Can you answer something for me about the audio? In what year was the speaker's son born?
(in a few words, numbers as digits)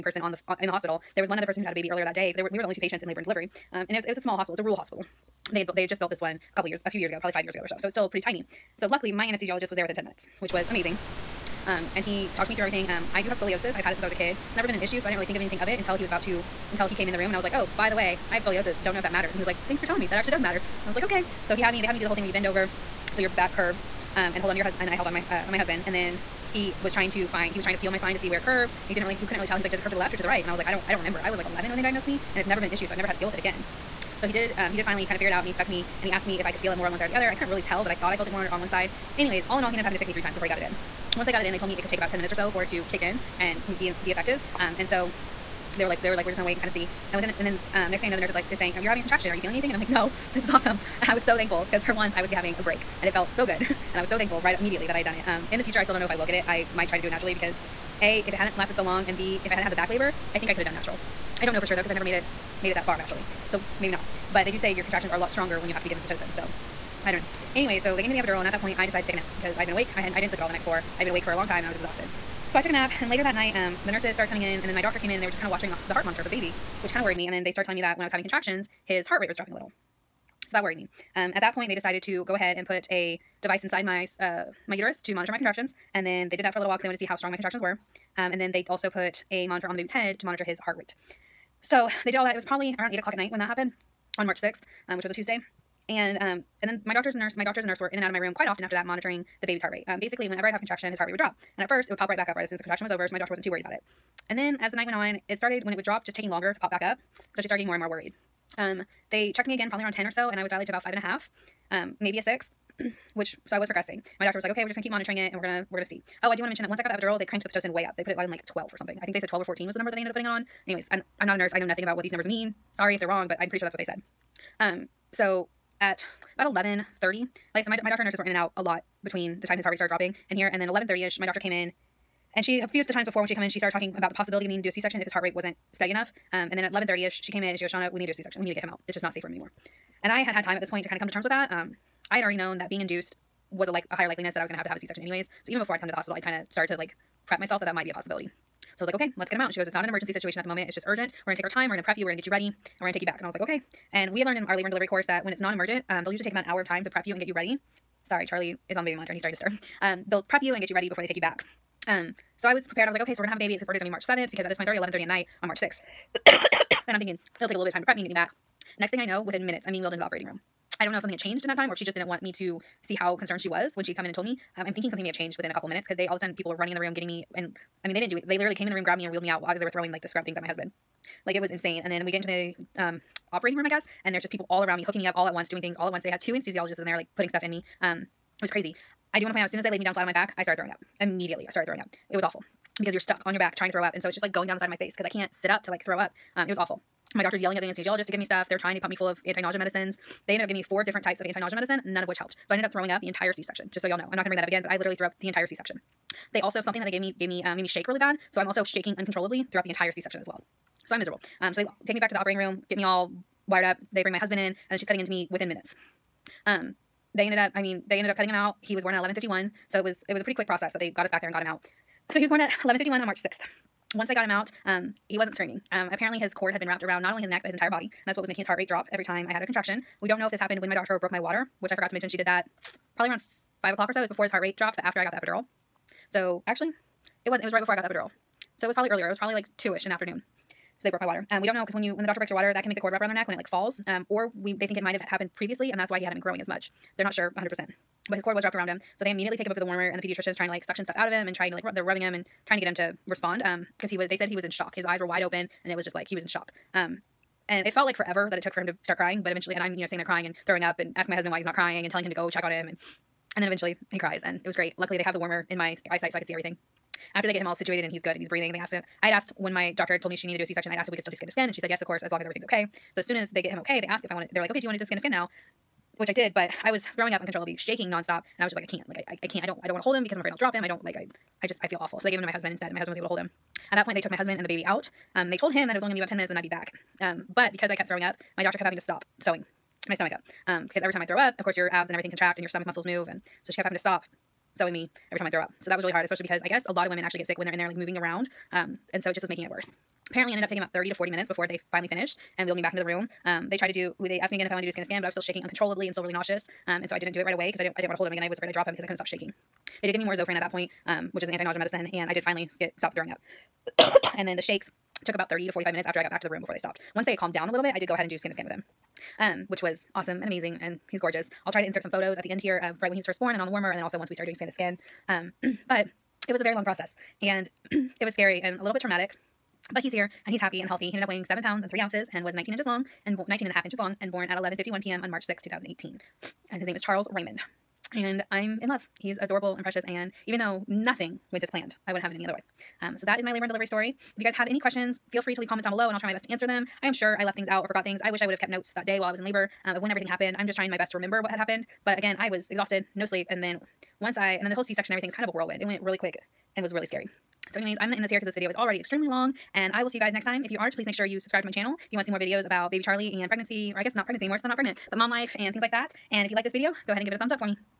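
2018.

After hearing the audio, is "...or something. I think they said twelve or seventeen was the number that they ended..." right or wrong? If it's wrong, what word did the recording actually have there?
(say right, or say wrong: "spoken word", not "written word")
wrong: "fourteen", not "seventeen".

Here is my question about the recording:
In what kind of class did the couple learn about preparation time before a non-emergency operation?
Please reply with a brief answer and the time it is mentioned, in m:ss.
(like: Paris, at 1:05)
labor and delivery course, at 2:34.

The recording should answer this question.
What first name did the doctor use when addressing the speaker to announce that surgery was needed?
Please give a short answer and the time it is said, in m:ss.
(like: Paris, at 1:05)
Shawna, at 2:17.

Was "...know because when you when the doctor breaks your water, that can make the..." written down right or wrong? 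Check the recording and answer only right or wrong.
right.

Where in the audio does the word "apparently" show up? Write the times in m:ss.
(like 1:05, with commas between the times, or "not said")
3:45, 5:00.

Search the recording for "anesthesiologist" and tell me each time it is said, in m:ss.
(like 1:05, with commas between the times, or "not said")
0:09, 3:06, 3:17.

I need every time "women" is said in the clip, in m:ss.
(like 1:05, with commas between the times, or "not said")
4:56.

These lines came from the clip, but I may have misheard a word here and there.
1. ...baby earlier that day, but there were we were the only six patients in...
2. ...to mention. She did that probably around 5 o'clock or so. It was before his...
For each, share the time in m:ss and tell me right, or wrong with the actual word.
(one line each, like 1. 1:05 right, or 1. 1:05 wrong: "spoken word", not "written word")
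1. 0:01 wrong: "two", not "six"
2. 3:51 right.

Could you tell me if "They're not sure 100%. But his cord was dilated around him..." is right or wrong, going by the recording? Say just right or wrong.
wrong.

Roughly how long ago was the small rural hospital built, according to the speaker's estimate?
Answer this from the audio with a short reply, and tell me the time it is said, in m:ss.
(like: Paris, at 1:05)
5 years ago, at 0:07.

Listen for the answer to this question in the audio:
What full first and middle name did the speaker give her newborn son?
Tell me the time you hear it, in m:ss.
5:36.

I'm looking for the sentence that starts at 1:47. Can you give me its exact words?
So she started getting more and more worried.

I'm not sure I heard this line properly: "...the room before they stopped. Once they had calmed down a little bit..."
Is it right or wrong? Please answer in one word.
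right.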